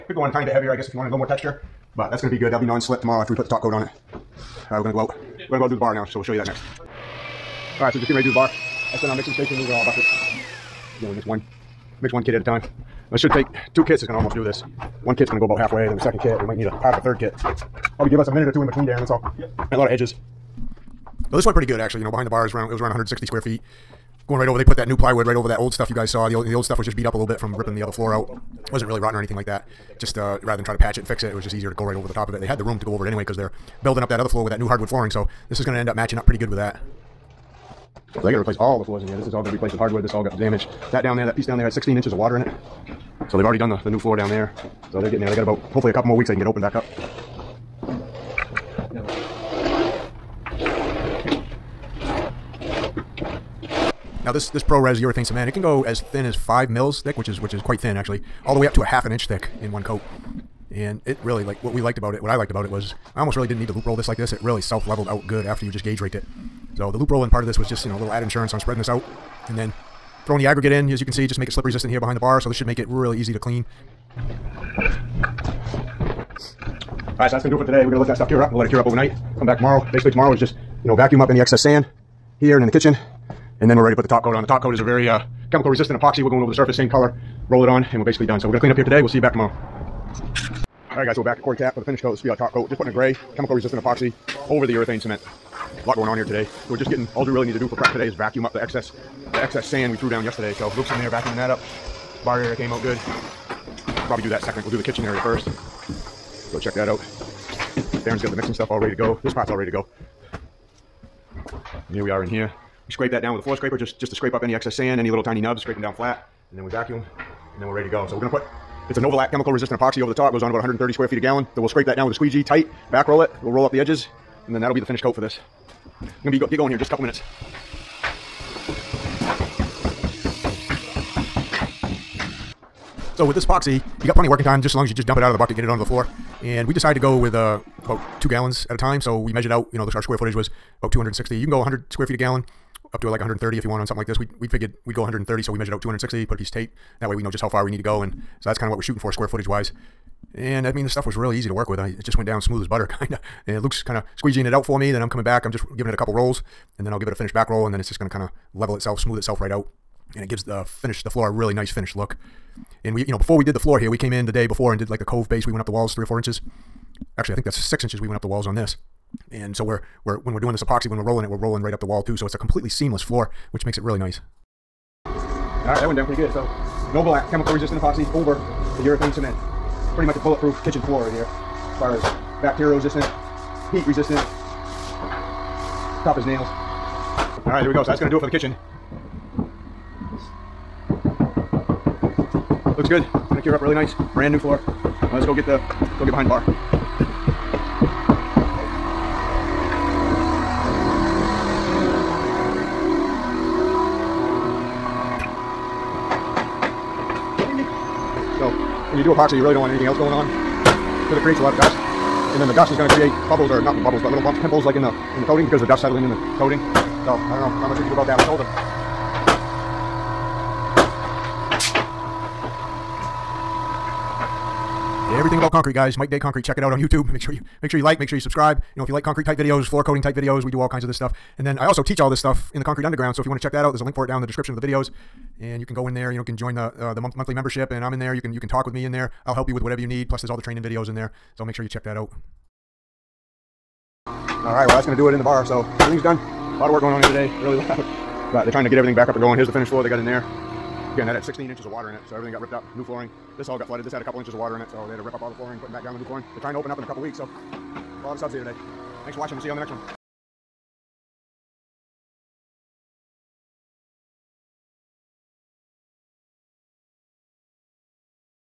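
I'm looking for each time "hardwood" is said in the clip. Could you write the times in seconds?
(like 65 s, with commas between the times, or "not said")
34 s, 39 s.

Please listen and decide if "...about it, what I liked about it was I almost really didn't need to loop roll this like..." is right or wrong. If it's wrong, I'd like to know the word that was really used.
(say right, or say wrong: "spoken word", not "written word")
right.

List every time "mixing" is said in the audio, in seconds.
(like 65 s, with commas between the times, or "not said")
9 s, 108 s.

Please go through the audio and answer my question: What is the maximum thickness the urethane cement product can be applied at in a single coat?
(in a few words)
half an inch.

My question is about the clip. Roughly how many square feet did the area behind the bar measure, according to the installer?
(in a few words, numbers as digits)
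160 square feet.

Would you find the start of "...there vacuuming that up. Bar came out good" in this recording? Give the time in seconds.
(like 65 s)
100 s.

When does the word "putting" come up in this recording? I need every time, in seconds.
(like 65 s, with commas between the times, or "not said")
92 s, 255 s.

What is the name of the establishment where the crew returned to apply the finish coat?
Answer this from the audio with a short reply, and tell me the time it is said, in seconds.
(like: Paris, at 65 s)
Quarry Tap, at 91 s.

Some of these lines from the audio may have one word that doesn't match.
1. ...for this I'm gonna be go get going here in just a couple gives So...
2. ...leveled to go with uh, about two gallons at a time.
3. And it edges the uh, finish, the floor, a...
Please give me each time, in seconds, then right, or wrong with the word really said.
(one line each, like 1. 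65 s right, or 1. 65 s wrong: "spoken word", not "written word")
1. 125 s wrong: "minutes", not "gives"
2. 136 s wrong: "decided", not "leveled"
3. 160 s wrong: "gives", not "edges".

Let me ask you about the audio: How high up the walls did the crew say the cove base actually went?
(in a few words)
6 inches.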